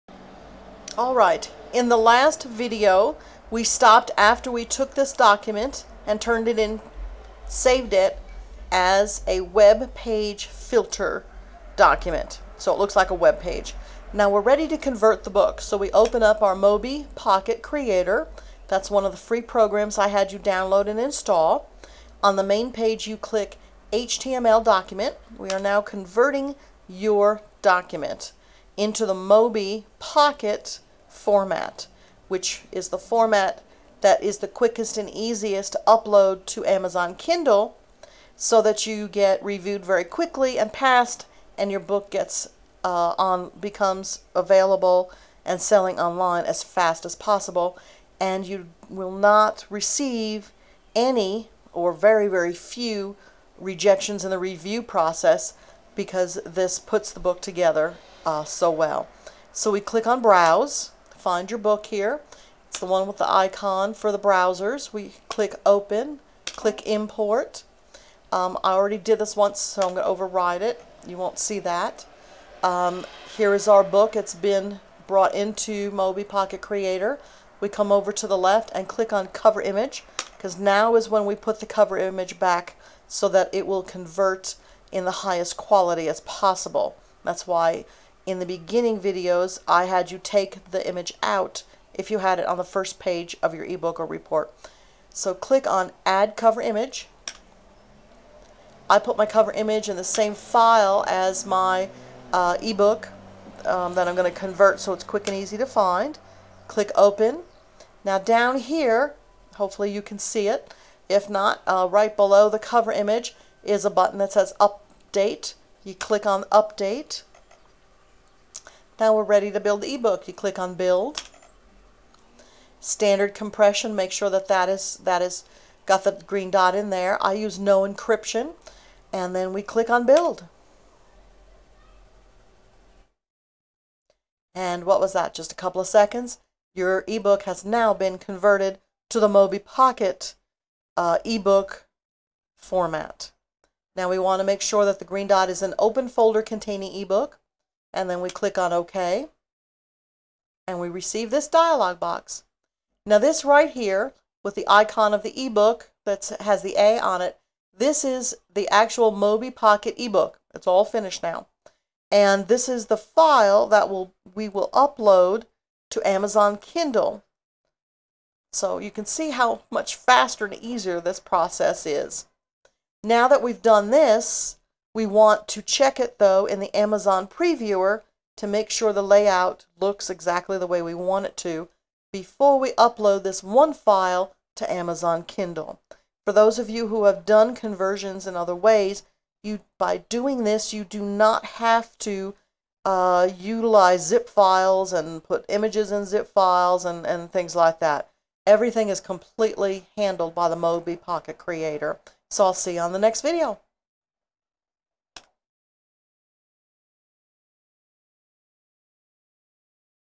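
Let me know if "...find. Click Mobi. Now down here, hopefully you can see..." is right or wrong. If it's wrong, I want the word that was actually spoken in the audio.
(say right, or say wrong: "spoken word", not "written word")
wrong: "Open", not "Mobi".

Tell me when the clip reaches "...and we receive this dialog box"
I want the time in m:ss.
2:30.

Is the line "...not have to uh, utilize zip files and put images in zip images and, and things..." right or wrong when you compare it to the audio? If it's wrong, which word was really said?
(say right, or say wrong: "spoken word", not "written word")
wrong: "files", not "images".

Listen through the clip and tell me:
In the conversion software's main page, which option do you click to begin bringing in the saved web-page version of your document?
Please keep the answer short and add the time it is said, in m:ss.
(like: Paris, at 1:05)
HTML document, at 0:23.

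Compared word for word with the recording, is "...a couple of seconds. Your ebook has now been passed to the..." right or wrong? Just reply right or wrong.
wrong.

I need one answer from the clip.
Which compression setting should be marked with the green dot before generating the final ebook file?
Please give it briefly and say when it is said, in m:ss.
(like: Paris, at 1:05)
Standard compression, at 2:02.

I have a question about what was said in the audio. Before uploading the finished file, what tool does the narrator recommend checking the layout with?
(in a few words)
Amazon Previewer.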